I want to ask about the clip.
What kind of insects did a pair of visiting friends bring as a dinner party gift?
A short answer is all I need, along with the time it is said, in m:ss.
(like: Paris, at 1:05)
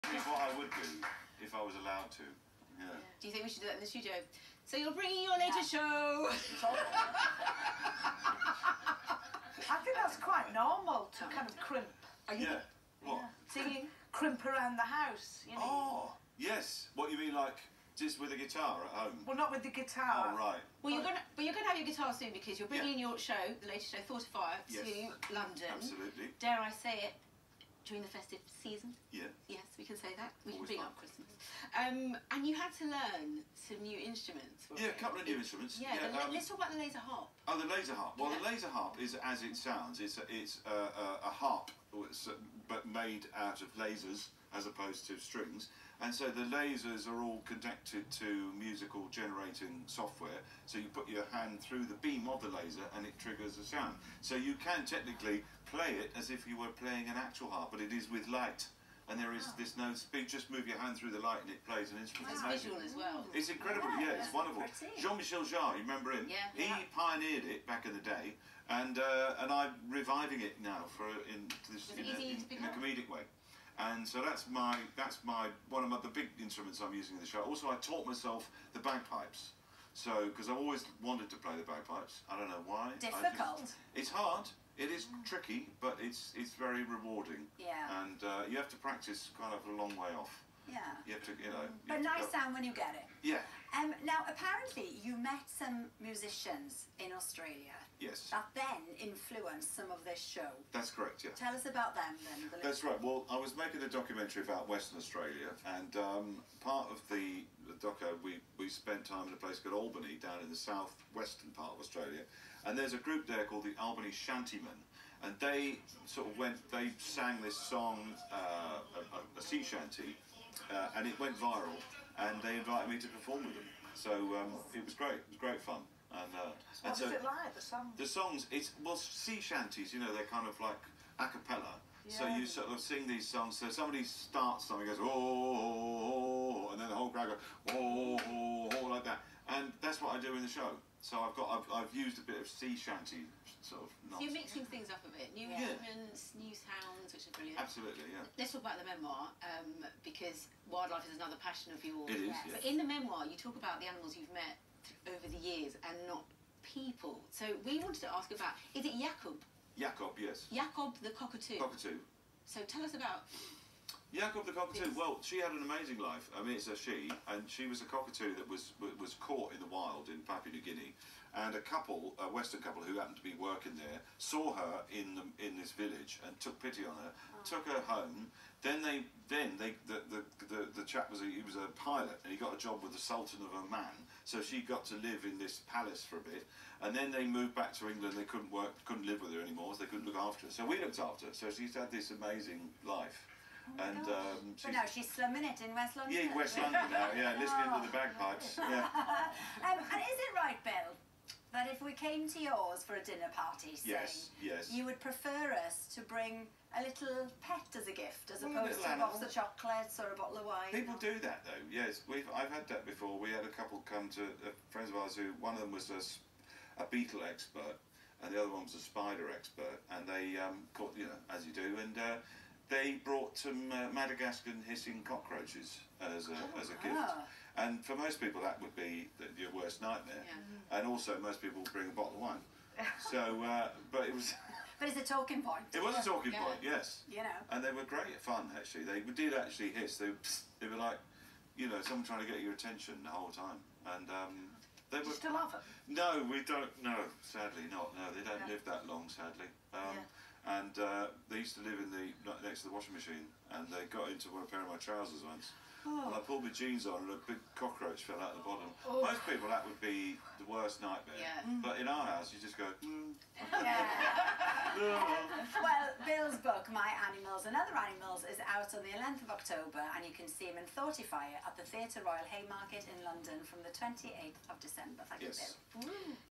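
Madagascan hissing cockroaches, at 3:43.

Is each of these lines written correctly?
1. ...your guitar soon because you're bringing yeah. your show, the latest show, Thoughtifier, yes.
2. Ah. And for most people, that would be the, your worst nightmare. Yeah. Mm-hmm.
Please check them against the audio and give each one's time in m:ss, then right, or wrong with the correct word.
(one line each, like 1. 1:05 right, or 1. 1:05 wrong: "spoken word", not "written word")
1. 0:21 right
2. 3:46 right.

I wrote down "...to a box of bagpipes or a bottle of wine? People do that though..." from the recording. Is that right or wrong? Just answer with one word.
wrong.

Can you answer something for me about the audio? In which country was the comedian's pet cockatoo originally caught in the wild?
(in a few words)
Papua New Guinea.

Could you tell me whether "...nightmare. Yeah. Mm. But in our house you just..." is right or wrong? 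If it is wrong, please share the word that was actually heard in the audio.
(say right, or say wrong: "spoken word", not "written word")
right.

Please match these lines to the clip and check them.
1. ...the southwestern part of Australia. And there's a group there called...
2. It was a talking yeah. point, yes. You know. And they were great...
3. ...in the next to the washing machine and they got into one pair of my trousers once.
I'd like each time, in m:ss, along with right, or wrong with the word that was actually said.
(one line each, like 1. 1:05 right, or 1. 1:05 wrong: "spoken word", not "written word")
1. 1:50 right
2. 3:55 right
3. 4:11 right.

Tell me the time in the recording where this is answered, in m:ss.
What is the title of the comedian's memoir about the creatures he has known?
4:26.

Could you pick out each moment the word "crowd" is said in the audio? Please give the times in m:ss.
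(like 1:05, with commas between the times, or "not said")
2:17.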